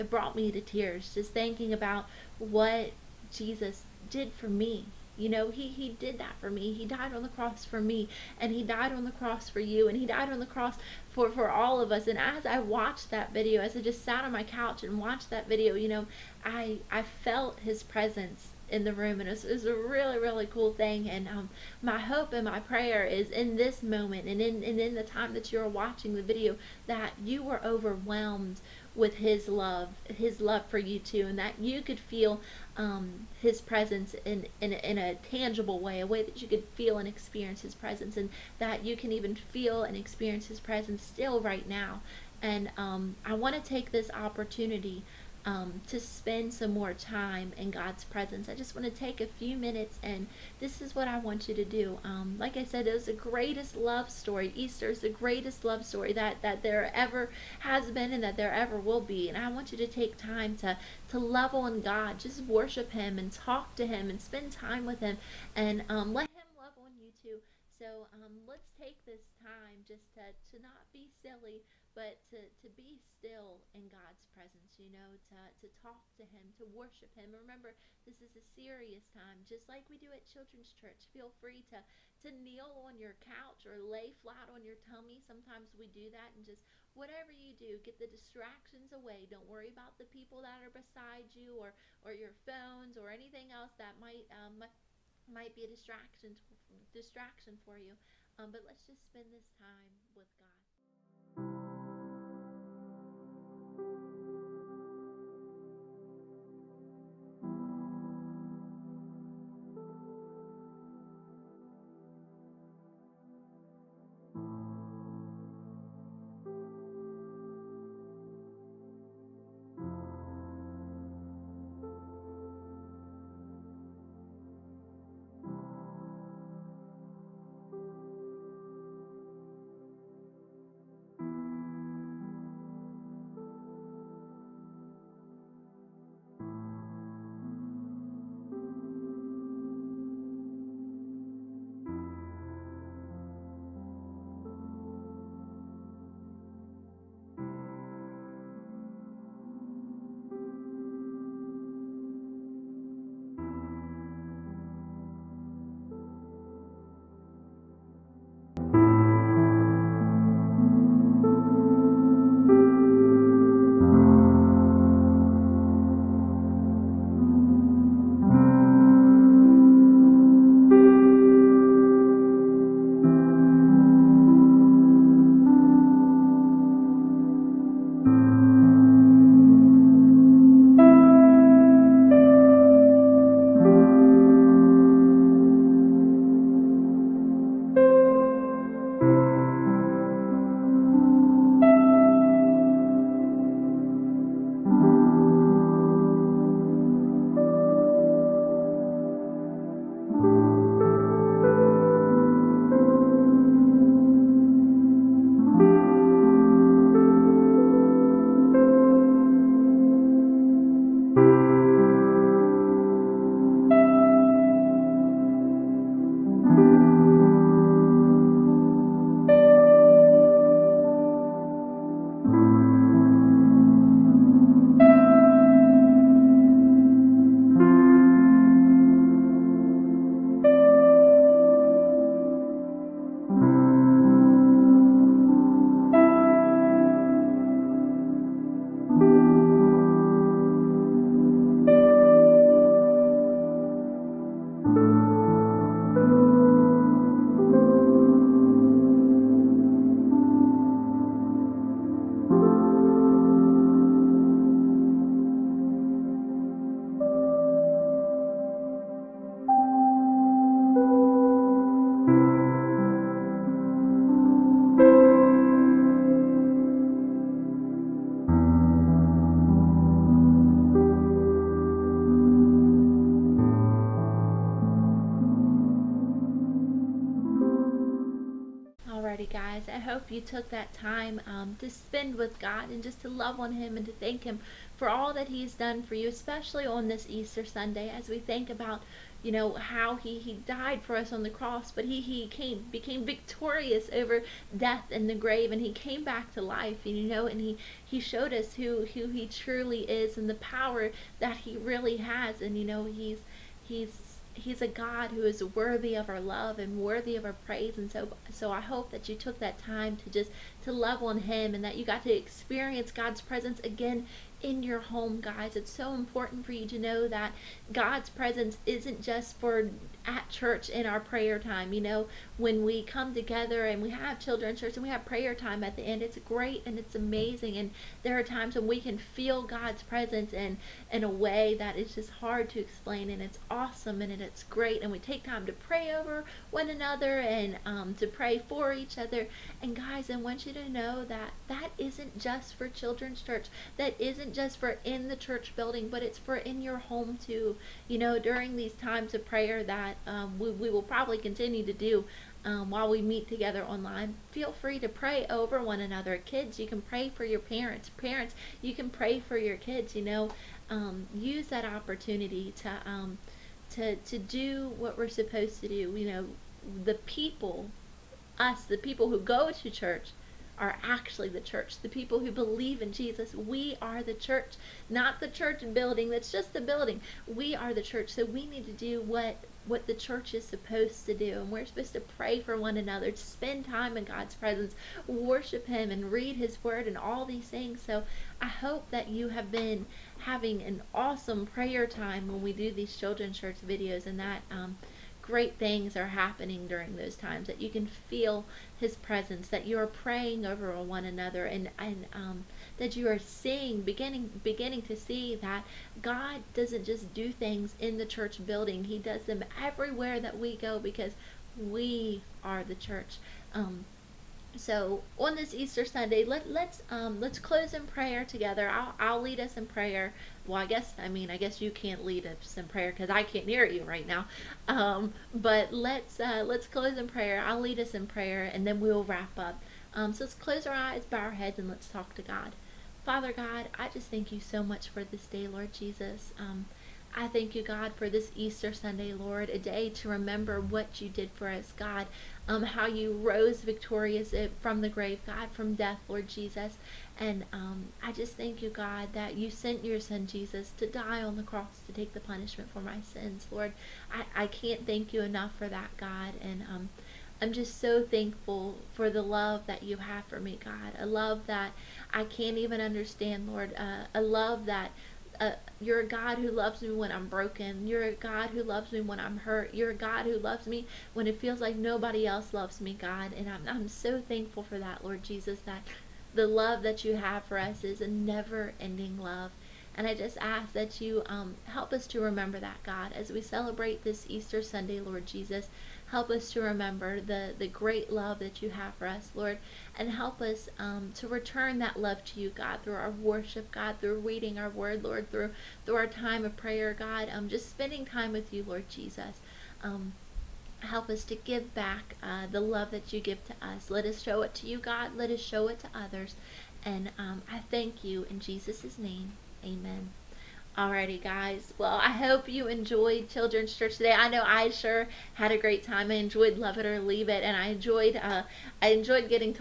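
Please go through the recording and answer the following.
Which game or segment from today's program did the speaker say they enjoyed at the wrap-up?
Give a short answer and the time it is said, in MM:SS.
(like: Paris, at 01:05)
Love It or Leave It, at 08:36.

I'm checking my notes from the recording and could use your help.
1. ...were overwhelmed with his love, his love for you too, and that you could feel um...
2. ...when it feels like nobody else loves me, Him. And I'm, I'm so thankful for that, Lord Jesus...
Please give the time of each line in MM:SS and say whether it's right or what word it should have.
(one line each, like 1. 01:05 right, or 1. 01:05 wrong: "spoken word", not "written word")
1. 00:27 right
2. 07:51 wrong: "God", not "Him".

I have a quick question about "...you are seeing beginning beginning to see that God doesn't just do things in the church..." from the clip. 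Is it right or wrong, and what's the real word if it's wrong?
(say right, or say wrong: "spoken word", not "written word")
right.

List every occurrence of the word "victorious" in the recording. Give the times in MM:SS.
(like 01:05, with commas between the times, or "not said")
04:53, 07:23.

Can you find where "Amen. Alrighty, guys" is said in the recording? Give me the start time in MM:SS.
08:29.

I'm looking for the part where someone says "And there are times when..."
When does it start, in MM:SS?
05:27.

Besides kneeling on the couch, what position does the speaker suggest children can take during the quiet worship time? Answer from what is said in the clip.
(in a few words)
Flat on your tummy.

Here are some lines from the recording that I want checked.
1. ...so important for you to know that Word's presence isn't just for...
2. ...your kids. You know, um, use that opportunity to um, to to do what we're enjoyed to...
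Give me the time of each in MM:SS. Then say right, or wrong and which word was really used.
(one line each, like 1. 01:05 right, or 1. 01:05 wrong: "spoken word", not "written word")
1. 05:15 wrong: "God", not "Word"
2. 05:59 wrong: "supposed", not "enjoyed".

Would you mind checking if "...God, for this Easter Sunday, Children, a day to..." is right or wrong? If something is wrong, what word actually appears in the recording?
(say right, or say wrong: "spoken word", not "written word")
wrong: "Lord", not "Children".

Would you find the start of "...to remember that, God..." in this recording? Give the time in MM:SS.
08:02.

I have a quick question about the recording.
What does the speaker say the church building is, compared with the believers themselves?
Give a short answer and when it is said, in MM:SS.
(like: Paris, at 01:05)
Just the building, at 06:16.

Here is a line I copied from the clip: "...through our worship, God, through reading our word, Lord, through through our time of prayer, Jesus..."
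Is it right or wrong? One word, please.
wrong.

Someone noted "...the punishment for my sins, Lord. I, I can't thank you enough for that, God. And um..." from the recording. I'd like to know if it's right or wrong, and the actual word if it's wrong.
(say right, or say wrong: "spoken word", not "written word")
right.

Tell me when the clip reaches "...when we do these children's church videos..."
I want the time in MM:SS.
06:32.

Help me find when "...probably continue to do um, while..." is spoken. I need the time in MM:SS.
05:50.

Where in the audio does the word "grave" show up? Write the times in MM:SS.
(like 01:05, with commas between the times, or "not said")
04:55, 07:24.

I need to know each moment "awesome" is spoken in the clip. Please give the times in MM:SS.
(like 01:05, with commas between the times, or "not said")
05:33, 06:30.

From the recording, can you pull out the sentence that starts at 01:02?
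Just worship Him and talk to Him and spend time with Him and um, let Him love on you too.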